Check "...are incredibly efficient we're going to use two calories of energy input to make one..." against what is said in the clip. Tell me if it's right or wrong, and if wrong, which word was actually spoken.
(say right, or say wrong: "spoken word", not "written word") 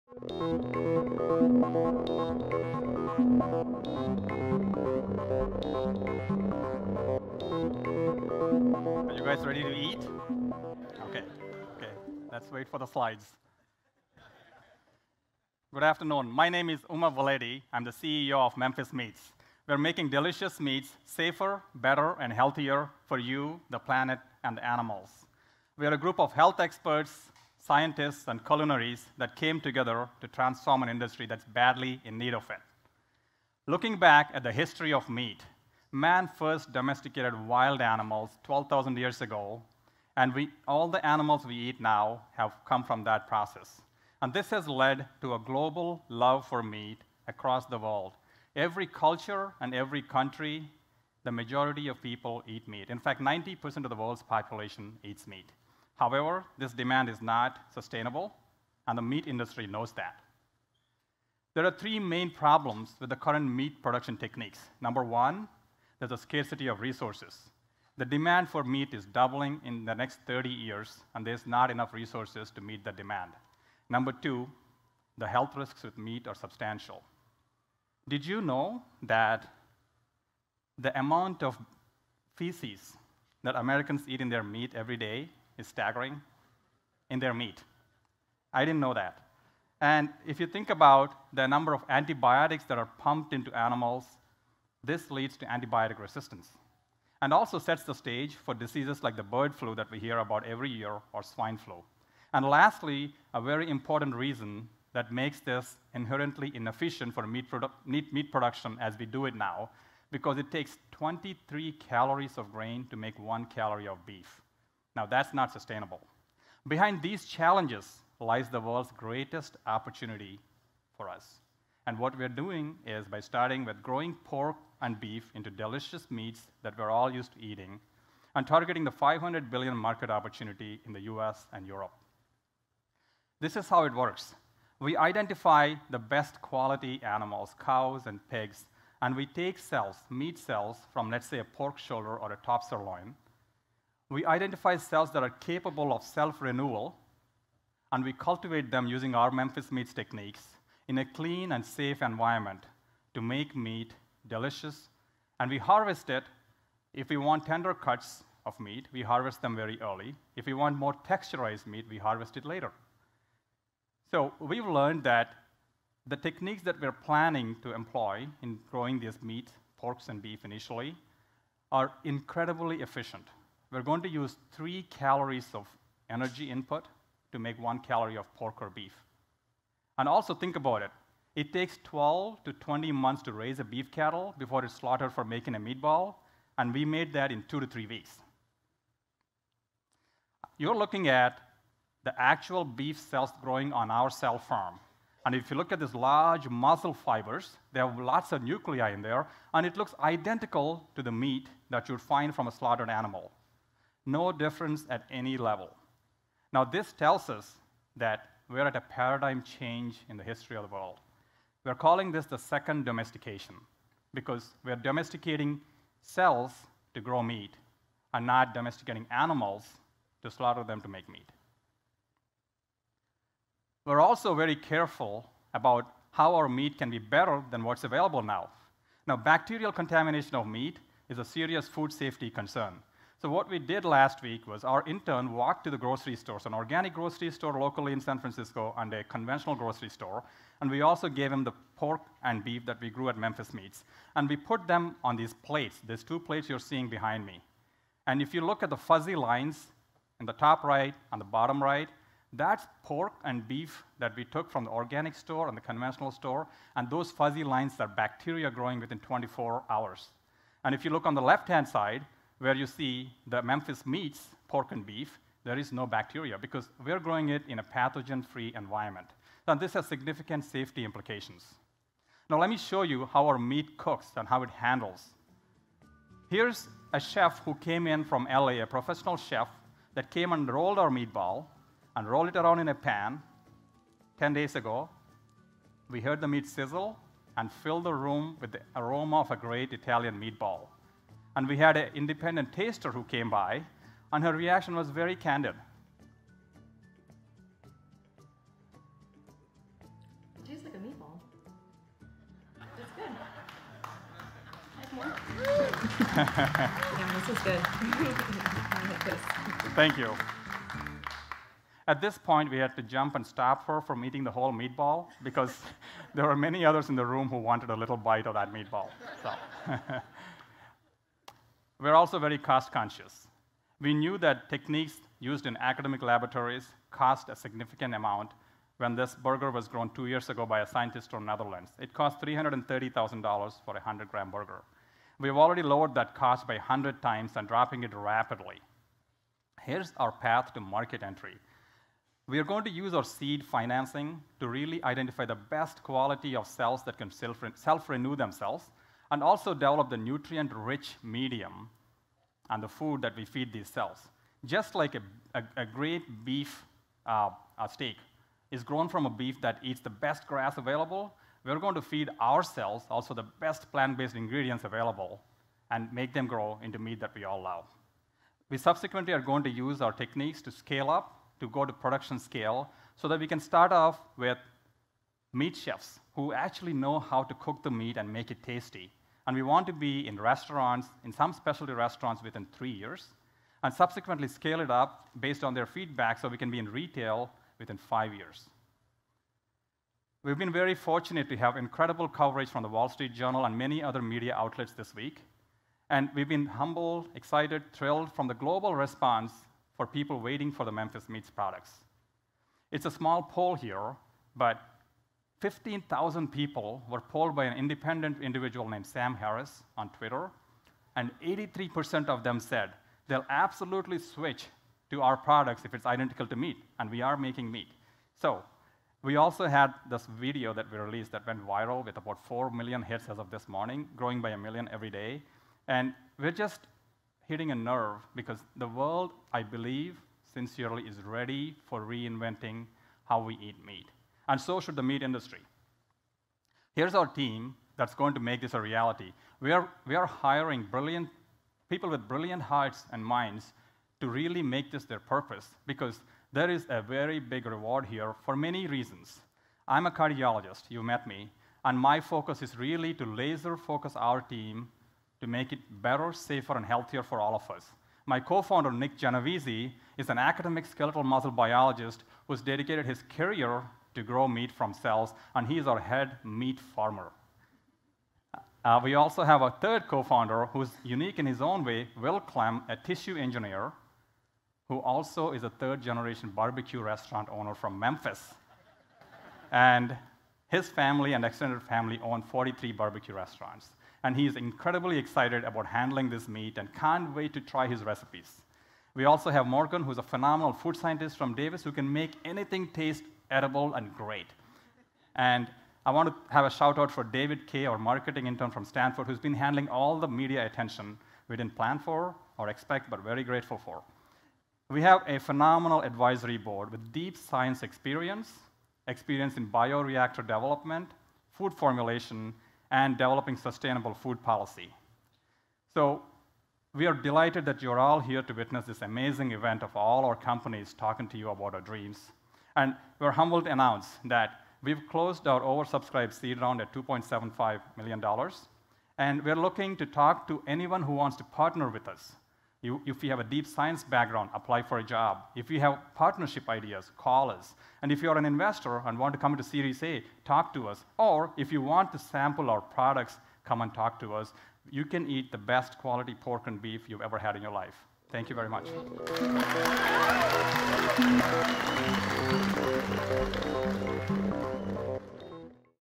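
wrong: "three", not "two".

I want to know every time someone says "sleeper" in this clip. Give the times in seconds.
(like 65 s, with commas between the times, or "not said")
not said.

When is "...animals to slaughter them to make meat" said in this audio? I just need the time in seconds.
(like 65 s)
219 s.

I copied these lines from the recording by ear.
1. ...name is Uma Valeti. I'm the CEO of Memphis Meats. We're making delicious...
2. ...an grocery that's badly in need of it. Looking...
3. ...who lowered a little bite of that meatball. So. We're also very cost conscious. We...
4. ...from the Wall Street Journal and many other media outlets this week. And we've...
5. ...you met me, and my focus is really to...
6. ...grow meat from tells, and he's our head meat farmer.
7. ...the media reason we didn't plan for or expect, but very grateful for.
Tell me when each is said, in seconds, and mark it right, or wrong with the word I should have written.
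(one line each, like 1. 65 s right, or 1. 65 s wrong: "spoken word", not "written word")
1. 16 s right
2. 30 s wrong: "industry", not "grocery"
3. 317 s wrong: "wanted", not "lowered"
4. 392 s right
5. 450 s right
6. 464 s wrong: "cells", not "tells"
7. 499 s wrong: "attention", not "reason".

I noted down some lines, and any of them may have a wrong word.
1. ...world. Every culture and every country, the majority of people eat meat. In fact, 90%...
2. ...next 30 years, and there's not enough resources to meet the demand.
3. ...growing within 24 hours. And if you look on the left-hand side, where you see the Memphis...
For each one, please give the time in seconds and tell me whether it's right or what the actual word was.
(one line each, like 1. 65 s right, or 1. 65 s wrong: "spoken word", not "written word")
1. 47 s right
2. 69 s right
3. 258 s right.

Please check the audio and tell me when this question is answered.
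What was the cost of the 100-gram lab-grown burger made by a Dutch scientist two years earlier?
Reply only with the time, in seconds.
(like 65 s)
332 s.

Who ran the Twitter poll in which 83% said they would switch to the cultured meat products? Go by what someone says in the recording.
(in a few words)
Sam Harris.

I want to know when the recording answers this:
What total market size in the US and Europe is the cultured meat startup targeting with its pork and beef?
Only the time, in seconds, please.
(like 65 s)
128 s.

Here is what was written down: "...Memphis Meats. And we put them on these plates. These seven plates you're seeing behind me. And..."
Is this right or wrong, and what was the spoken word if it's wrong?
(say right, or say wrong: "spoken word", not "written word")
wrong: "two", not "seven".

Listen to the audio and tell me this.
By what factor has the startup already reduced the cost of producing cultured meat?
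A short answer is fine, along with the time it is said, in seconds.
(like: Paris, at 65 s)
100 times, at 336 s.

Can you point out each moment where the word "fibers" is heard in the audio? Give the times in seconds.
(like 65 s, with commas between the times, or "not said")
196 s.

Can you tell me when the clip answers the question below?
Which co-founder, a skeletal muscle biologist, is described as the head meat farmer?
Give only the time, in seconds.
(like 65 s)
458 s.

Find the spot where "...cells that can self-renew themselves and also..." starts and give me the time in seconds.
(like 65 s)
346 s.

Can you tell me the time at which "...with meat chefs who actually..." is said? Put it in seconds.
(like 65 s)
374 s.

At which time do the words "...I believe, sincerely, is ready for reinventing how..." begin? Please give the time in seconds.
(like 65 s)
429 s.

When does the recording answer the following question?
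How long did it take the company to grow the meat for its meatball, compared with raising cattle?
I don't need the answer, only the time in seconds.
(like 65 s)
187 s.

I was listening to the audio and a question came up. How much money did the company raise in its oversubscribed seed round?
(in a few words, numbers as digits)
$2.75 million.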